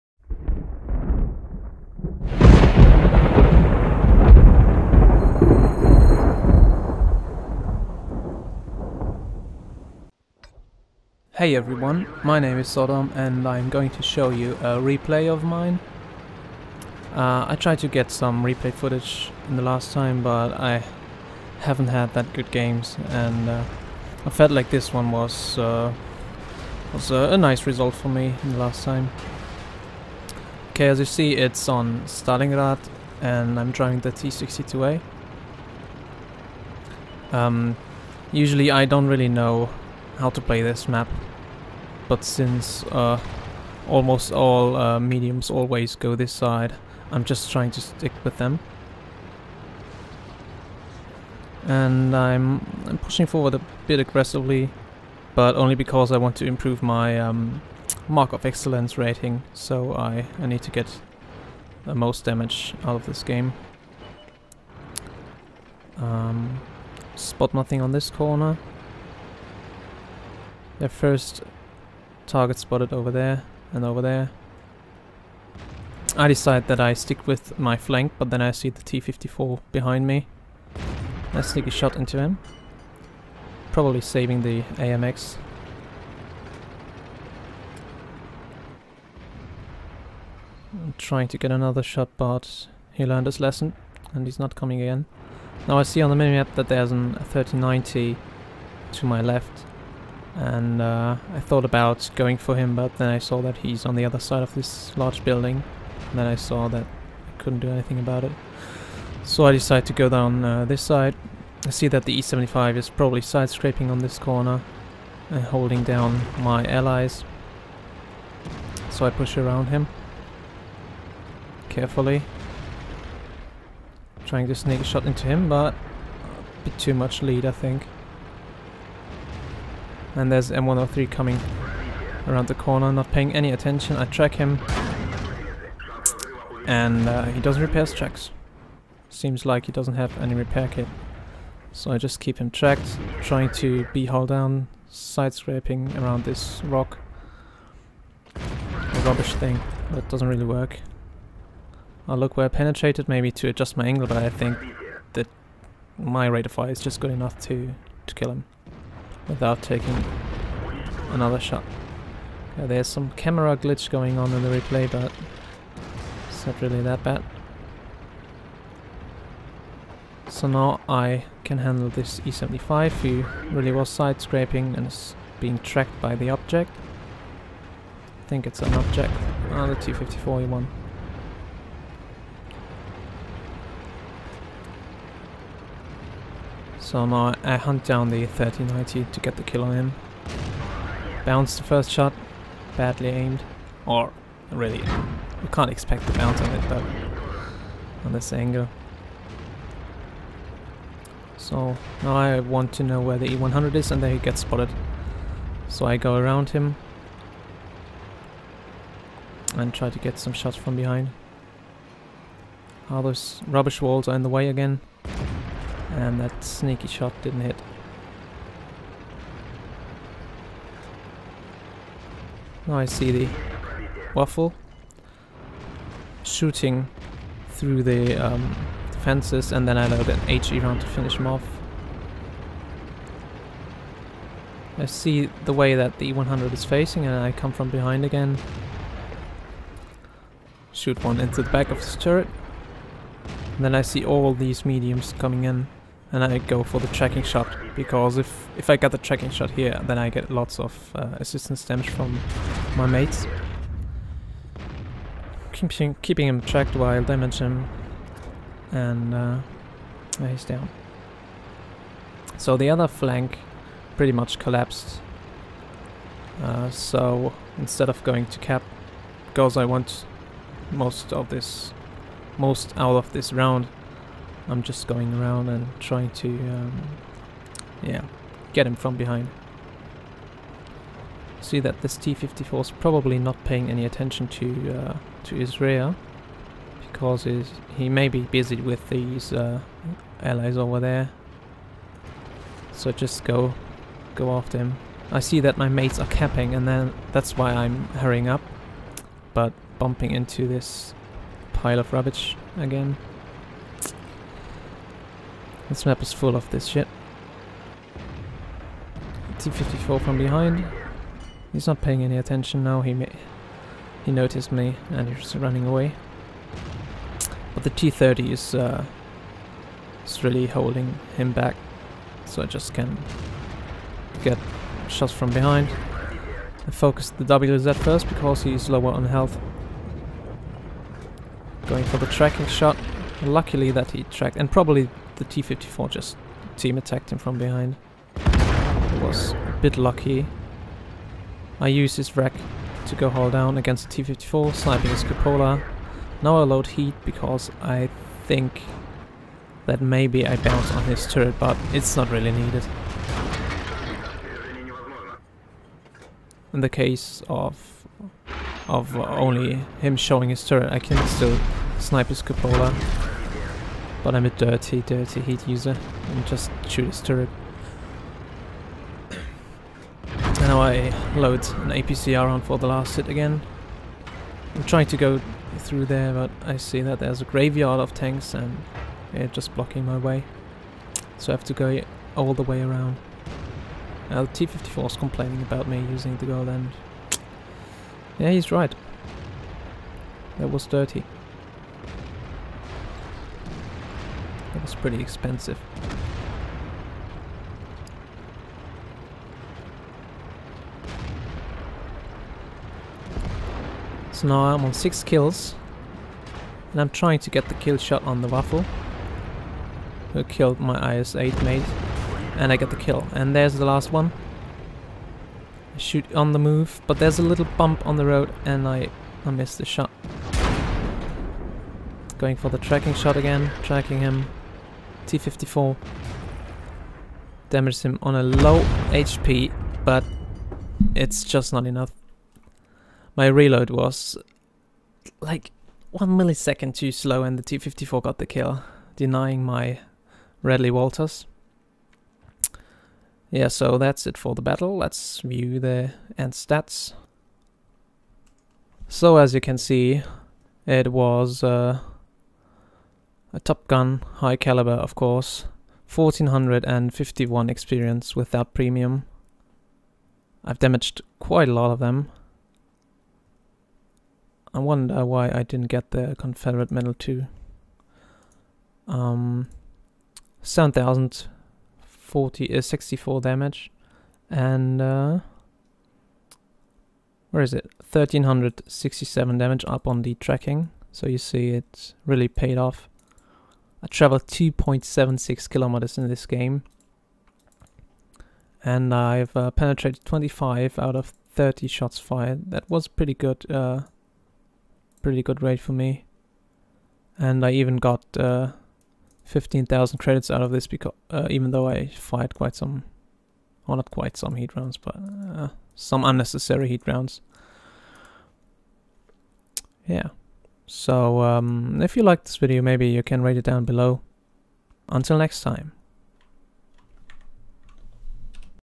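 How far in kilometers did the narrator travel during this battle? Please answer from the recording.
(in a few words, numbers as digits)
2.76 kilometers.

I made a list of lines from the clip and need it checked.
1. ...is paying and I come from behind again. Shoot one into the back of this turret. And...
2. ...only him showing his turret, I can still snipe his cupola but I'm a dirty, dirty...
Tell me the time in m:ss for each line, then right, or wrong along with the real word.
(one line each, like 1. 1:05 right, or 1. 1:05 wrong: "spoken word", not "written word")
1. 3:56 wrong: "facing", not "paying"
2. 5:58 right.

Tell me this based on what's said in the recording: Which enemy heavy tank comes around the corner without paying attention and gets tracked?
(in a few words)
M103.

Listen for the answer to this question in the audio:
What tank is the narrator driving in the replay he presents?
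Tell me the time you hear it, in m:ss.
0:34.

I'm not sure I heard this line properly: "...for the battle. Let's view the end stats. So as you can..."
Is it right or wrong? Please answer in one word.
right.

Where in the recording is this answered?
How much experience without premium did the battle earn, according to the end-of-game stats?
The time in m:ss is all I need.
7:35.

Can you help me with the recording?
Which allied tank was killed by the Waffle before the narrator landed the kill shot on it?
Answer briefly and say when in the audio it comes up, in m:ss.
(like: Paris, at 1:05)
IS-8, at 6:50.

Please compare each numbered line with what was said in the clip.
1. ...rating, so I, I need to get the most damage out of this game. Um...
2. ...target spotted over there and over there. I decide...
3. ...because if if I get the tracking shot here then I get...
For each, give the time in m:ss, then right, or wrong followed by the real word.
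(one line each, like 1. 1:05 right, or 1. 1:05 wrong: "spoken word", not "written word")
1. 0:58 right
2. 1:12 right
3. 4:07 right.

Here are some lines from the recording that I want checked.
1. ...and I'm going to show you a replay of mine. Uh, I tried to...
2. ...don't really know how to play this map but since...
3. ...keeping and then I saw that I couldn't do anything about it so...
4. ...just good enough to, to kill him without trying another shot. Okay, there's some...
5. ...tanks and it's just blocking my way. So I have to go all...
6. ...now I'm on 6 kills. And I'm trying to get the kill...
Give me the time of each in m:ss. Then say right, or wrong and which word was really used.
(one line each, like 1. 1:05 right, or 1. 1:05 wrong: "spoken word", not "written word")
1. 0:13 right
2. 0:38 right
3. 1:45 wrong: "building", not "keeping"
4. 2:36 wrong: "taking", not "trying"
5. 6:17 right
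6. 6:44 right.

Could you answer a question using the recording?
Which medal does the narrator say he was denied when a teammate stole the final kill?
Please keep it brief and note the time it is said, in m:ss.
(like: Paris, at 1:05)
Radley Walters, at 7:20.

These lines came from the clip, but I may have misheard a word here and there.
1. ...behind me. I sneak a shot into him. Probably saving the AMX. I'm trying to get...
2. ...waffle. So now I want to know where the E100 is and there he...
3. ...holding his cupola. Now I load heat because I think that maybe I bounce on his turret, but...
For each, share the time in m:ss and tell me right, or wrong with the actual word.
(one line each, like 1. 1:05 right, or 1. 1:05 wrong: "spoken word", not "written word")
1. 1:19 right
2. 3:18 wrong: "angle", not "waffle"
3. 5:44 wrong: "sniping", not "holding".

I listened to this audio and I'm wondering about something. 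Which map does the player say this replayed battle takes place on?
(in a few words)
Stalingrad.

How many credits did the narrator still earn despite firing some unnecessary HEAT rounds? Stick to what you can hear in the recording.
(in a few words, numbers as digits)
15,000.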